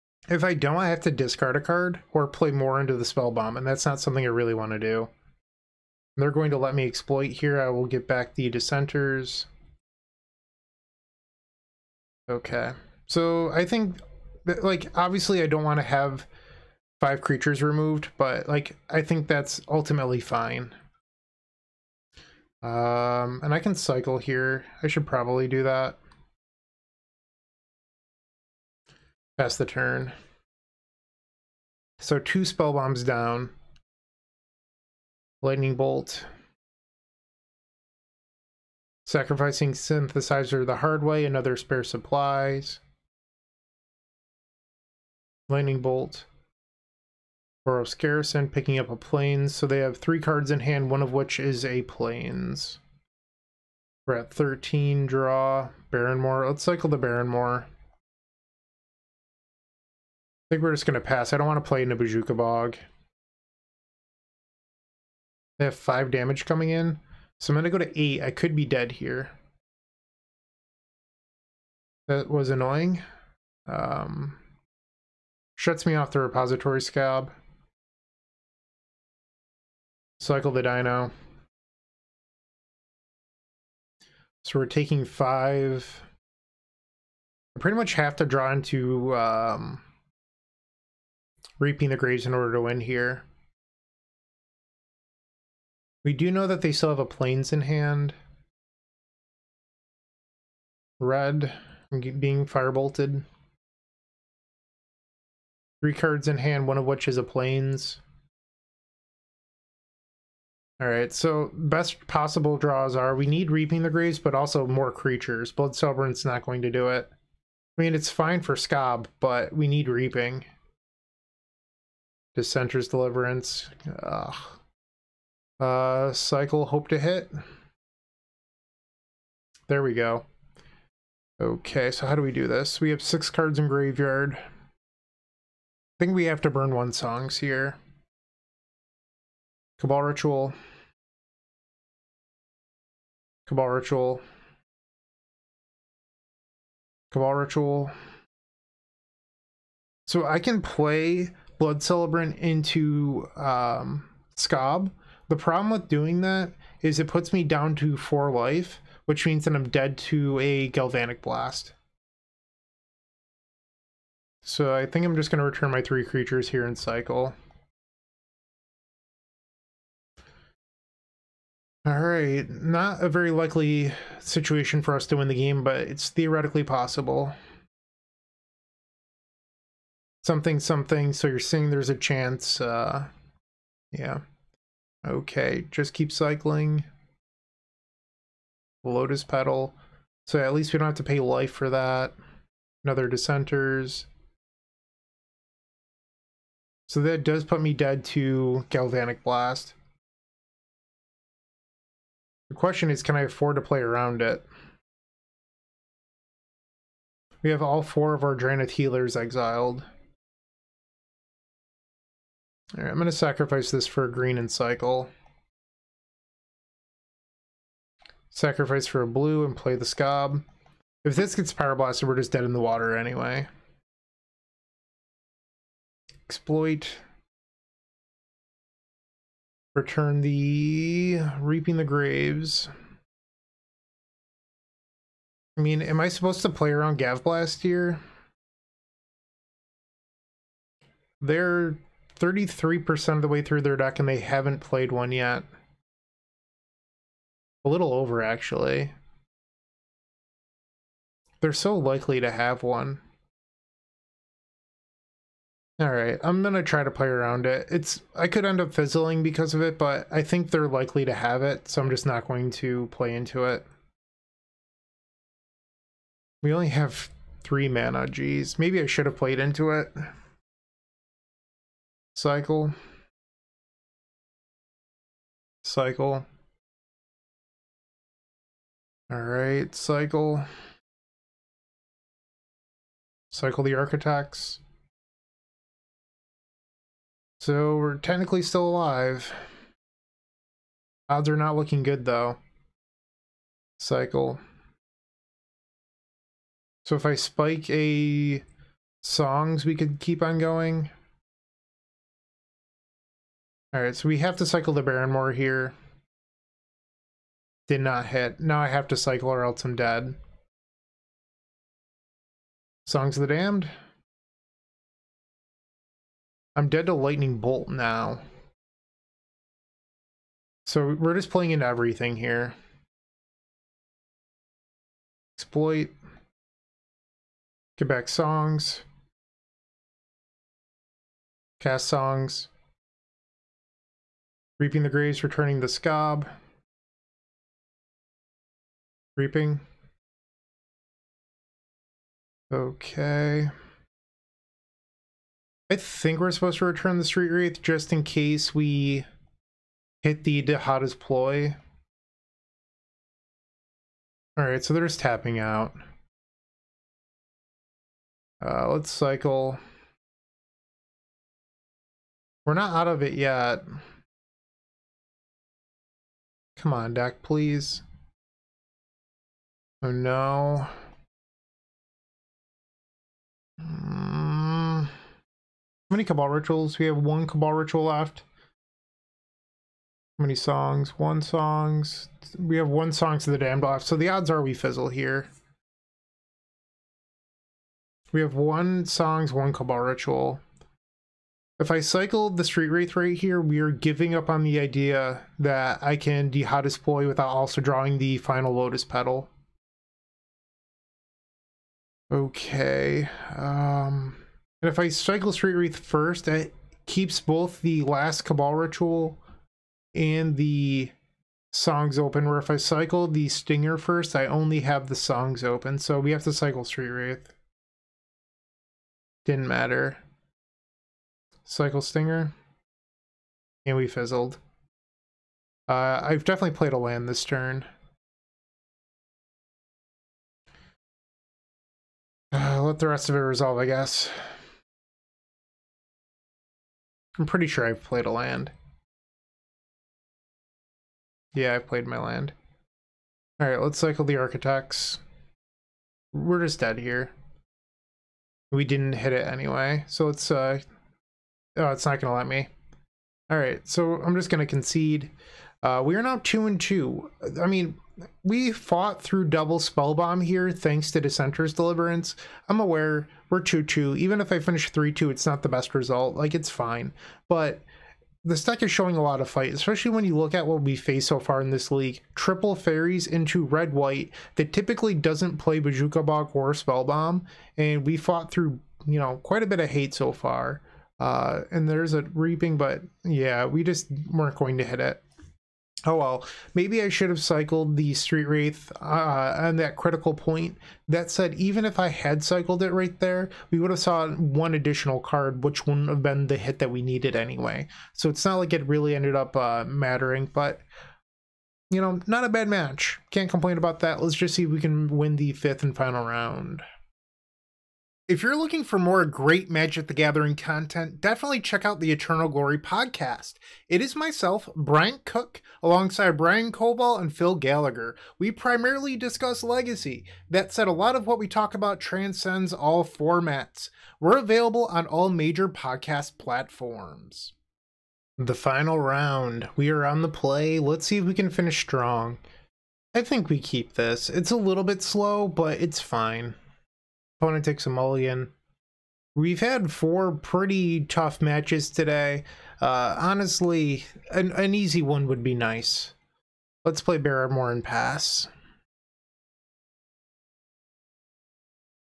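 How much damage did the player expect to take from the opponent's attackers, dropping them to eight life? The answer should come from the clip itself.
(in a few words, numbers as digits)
5.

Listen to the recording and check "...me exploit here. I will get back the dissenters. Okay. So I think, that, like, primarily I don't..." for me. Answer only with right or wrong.
wrong.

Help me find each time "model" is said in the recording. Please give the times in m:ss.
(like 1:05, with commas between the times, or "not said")
not said.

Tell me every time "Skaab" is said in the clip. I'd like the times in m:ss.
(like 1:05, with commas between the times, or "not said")
1:16, 1:58, 2:34, 3:39, 5:35.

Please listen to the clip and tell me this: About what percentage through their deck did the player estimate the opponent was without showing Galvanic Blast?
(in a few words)
33%.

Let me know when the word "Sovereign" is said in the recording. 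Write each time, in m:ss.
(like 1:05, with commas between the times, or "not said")
1:55.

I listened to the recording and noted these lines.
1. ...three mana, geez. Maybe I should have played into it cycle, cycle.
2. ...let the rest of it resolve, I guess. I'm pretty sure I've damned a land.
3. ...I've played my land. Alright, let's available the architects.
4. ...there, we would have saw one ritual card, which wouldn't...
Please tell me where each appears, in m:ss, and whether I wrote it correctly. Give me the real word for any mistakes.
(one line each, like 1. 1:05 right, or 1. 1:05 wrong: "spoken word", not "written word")
1. 4:27 right
2. 7:12 wrong: "played", not "damned"
3. 7:21 wrong: "cycle", not "available"
4. 8:12 wrong: "additional", not "ritual".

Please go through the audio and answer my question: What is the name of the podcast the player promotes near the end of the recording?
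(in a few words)
Eternal Glory.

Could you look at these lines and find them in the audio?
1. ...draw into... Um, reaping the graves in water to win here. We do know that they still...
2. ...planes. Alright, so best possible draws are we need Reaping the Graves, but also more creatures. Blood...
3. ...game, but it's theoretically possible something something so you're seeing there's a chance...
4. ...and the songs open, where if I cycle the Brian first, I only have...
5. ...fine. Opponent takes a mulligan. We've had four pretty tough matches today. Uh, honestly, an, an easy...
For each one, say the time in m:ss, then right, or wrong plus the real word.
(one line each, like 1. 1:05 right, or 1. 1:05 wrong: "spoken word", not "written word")
1. 1:28 wrong: "order", not "water"
2. 1:47 right
3. 2:55 right
4. 6:49 wrong: "Stinger", not "Brian"
5. 8:55 right.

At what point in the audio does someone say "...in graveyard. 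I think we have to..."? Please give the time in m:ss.
2:13.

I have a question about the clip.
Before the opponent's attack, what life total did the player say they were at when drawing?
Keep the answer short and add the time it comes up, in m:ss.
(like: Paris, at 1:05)
13, at 0:54.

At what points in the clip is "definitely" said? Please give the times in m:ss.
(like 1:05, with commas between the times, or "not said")
7:06, 8:30.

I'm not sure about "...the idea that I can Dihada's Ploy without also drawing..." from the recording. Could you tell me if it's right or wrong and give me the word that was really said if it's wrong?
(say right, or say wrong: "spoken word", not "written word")
right.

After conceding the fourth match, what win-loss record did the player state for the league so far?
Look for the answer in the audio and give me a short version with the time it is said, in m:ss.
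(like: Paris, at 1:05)
2 and 2, at 7:36.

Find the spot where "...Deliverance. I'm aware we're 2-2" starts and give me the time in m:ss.
7:41.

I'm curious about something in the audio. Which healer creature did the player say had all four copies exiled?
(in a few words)
Drannith healers.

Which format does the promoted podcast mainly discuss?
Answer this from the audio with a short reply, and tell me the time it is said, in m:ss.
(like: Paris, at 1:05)
legacy, at 8:39.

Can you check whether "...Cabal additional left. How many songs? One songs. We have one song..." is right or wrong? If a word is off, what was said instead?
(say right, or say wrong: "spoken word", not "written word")
wrong: "ritual", not "additional".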